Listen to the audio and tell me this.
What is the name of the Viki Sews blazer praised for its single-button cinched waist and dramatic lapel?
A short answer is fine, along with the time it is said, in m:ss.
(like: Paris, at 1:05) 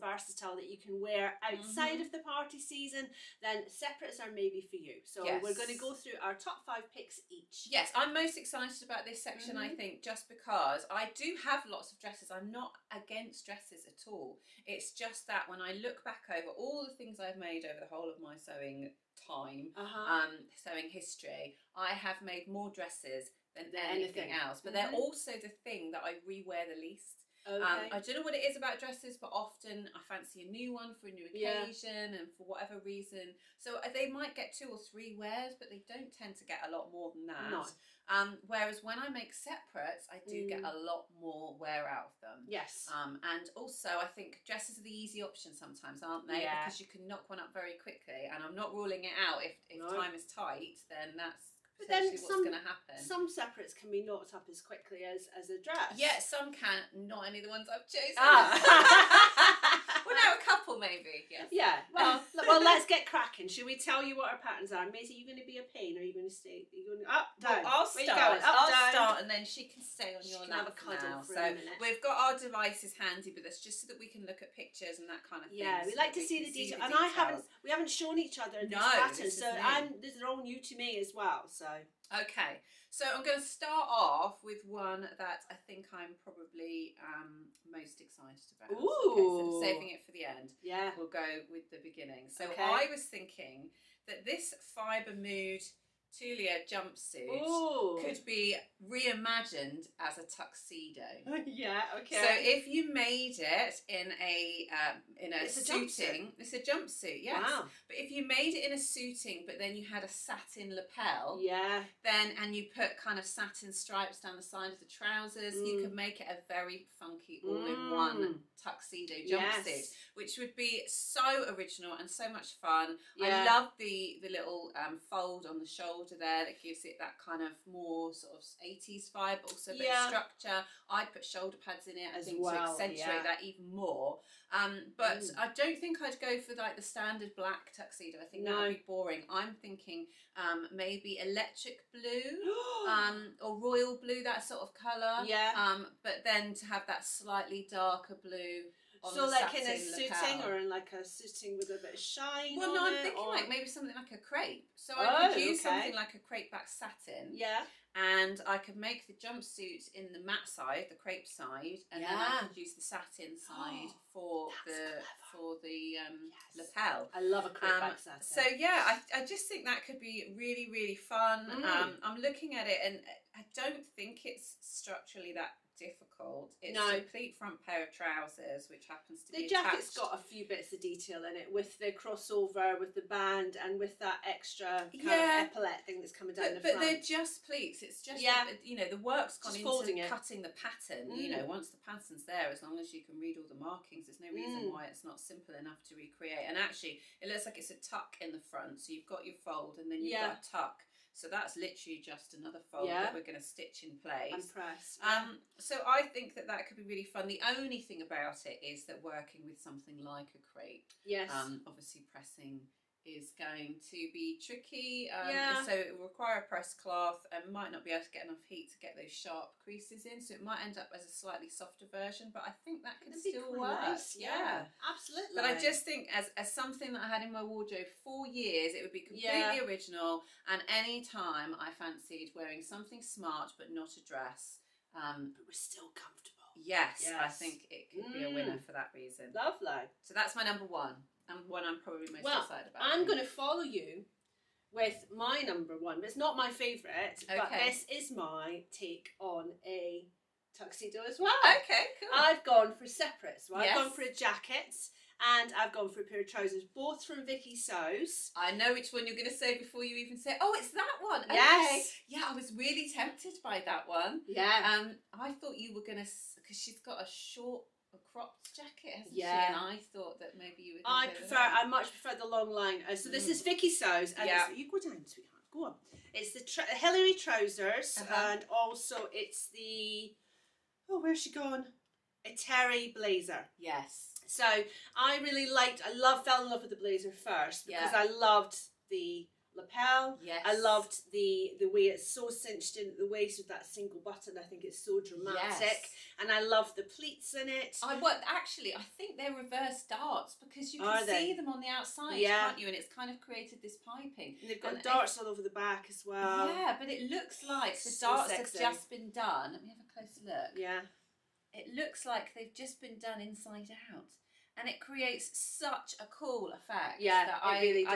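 Eteri, at 4:42.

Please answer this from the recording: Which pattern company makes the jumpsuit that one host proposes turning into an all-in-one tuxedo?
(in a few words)
Fibre Mood.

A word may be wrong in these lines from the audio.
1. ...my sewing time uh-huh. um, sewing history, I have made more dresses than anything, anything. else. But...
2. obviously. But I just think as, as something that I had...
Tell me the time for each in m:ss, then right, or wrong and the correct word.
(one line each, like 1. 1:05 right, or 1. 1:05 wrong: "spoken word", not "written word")
1. 0:18 right
2. 3:44 wrong: "absolutely", not "obviously".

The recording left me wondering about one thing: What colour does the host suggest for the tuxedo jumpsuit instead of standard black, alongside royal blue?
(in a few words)
Electric blue.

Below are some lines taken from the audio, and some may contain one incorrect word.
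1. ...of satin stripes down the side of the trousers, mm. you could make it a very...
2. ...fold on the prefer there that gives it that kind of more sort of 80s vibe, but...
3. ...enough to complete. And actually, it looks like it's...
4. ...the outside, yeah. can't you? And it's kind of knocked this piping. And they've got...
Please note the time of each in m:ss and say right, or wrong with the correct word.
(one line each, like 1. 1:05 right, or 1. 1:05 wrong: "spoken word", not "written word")
1. 1:53 right
2. 2:05 wrong: "shoulder", not "prefer"
3. 3:15 wrong: "recreate", not "complete"
4. 5:01 wrong: "created", not "knocked".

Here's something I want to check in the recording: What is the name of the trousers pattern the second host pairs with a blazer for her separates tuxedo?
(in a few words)
Hilary.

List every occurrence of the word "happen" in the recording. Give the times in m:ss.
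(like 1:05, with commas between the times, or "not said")
0:52, 2:58.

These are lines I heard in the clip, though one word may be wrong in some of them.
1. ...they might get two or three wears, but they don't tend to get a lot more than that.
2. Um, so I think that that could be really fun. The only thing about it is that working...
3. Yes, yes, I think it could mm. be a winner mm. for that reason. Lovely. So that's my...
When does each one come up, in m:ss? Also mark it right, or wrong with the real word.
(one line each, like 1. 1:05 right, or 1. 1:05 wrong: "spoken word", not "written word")
1. 0:33 right
2. 3:24 right
3. 3:56 right.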